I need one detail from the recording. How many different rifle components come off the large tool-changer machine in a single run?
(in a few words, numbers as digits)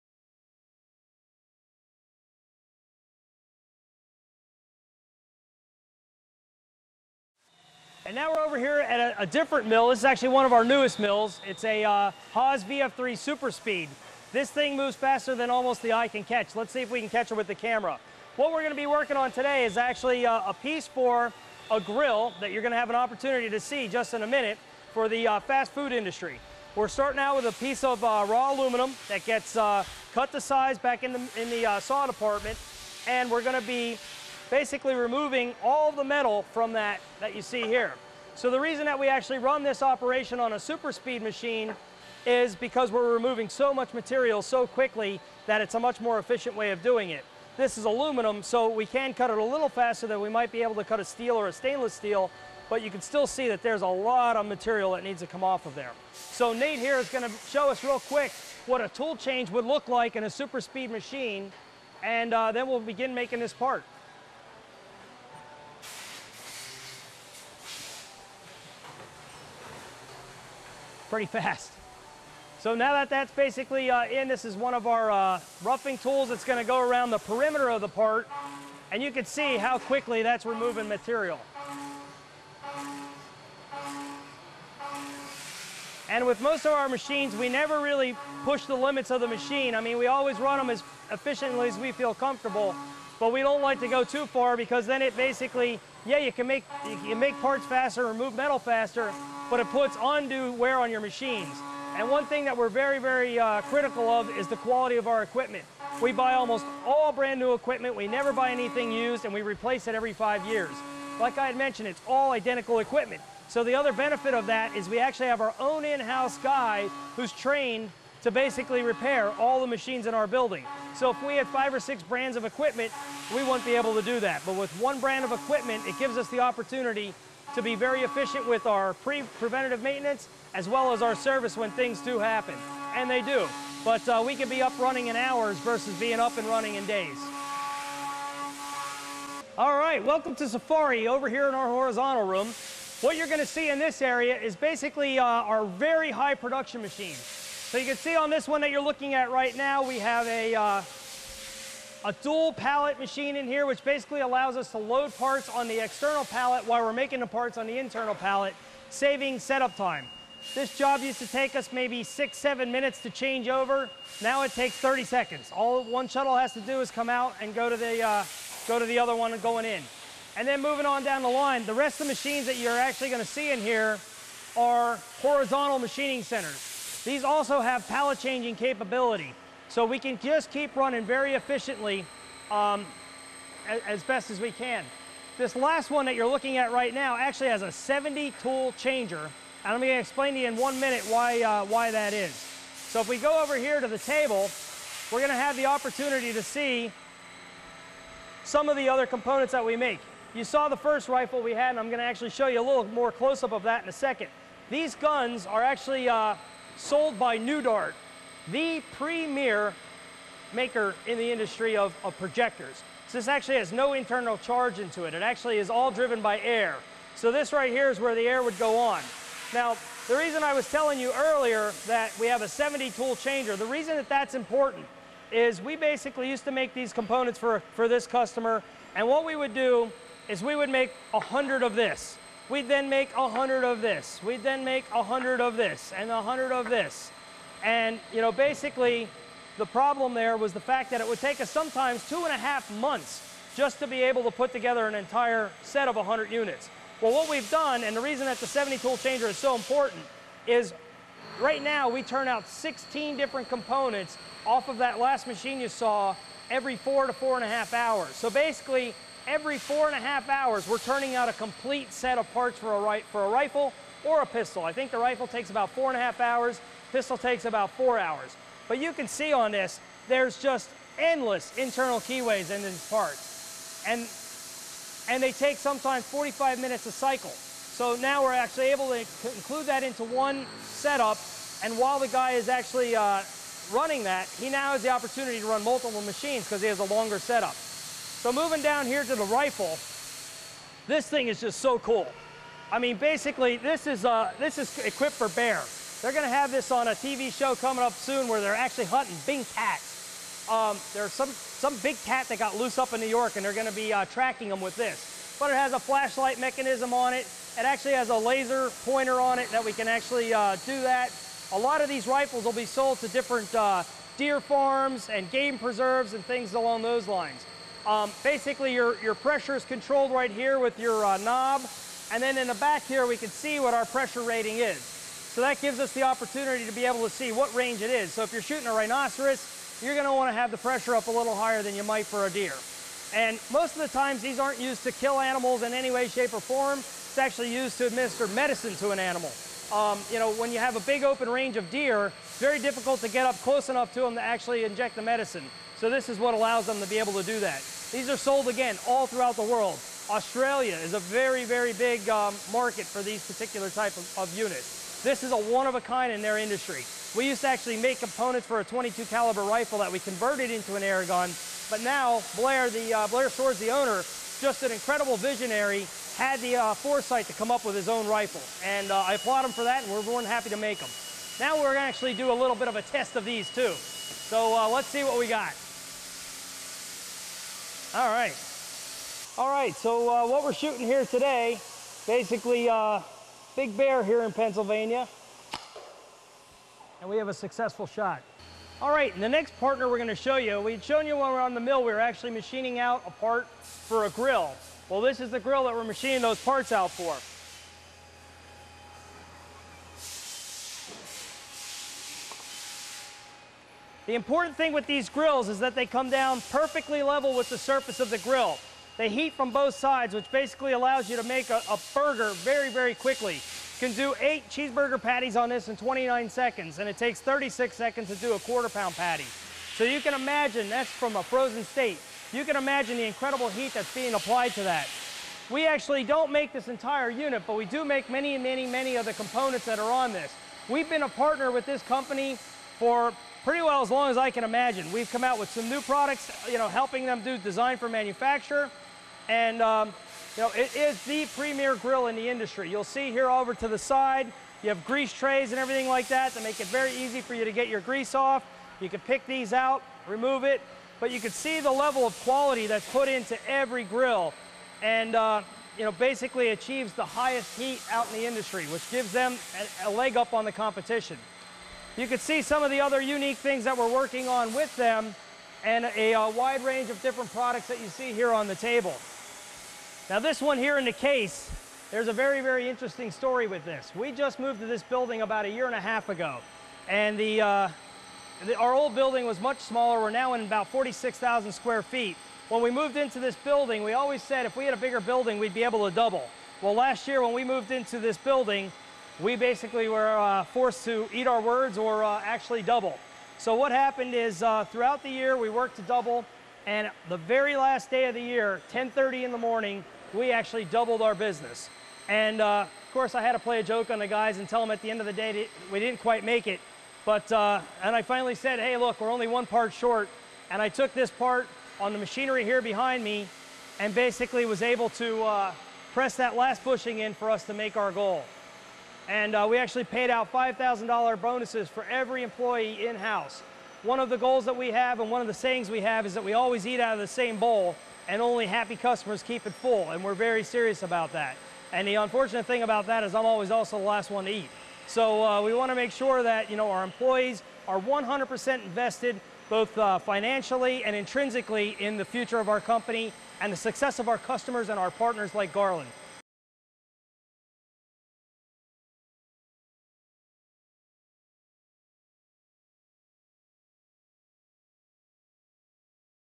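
16.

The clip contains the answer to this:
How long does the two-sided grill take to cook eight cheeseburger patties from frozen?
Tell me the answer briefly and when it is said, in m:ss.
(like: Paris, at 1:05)
29 seconds, at 6:55.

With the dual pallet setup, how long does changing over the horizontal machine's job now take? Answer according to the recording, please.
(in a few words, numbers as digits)
30 seconds.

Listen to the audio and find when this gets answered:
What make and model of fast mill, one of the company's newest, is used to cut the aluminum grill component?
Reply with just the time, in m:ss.
0:12.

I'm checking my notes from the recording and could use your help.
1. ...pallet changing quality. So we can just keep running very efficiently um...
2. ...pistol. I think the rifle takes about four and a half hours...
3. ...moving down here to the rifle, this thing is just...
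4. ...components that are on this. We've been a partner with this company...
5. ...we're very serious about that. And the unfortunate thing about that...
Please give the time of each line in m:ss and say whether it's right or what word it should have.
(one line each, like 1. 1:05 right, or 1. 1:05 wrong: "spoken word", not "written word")
1. 2:57 wrong: "capability", not "quality"
2. 4:24 right
3. 4:48 right
4. 7:09 right
5. 8:50 right.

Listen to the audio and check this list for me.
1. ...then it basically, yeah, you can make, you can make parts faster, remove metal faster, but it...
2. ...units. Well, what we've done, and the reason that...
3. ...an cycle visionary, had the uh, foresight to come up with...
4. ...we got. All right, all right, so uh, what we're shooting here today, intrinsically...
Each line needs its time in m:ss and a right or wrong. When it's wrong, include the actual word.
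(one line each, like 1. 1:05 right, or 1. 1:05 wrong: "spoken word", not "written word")
1. 1:34 right
2. 4:06 right
3. 6:04 wrong: "incredible", not "cycle"
4. 6:15 wrong: "basically", not "intrinsically".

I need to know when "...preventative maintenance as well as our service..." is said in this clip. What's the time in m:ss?
2:09.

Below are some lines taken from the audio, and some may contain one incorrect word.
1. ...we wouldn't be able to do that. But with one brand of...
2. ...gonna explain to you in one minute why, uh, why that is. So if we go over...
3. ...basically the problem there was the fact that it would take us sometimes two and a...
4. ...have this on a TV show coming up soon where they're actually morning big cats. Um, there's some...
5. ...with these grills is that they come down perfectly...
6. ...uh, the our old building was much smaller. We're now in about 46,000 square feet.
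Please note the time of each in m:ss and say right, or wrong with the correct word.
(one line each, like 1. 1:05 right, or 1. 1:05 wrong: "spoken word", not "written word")
1. 2:03 right
2. 3:09 right
3. 3:58 right
4. 4:56 wrong: "hunting", not "morning"
5. 6:44 right
6. 7:57 right.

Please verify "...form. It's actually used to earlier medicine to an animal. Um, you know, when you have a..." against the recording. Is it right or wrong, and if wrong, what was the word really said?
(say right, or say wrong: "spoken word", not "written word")
wrong: "administer", not "earlier".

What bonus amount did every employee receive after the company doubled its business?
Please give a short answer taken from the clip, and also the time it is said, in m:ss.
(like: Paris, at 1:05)
$5,000, at 8:40.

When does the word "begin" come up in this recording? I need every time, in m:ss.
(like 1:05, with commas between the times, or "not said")
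1:02.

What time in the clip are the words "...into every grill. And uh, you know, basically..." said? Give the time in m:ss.
7:33.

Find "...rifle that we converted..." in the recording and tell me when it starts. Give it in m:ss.
5:59.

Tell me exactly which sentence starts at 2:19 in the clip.
All right, welcome to Safari over here in our horizontal room.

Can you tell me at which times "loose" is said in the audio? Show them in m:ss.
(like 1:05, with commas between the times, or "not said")
5:02.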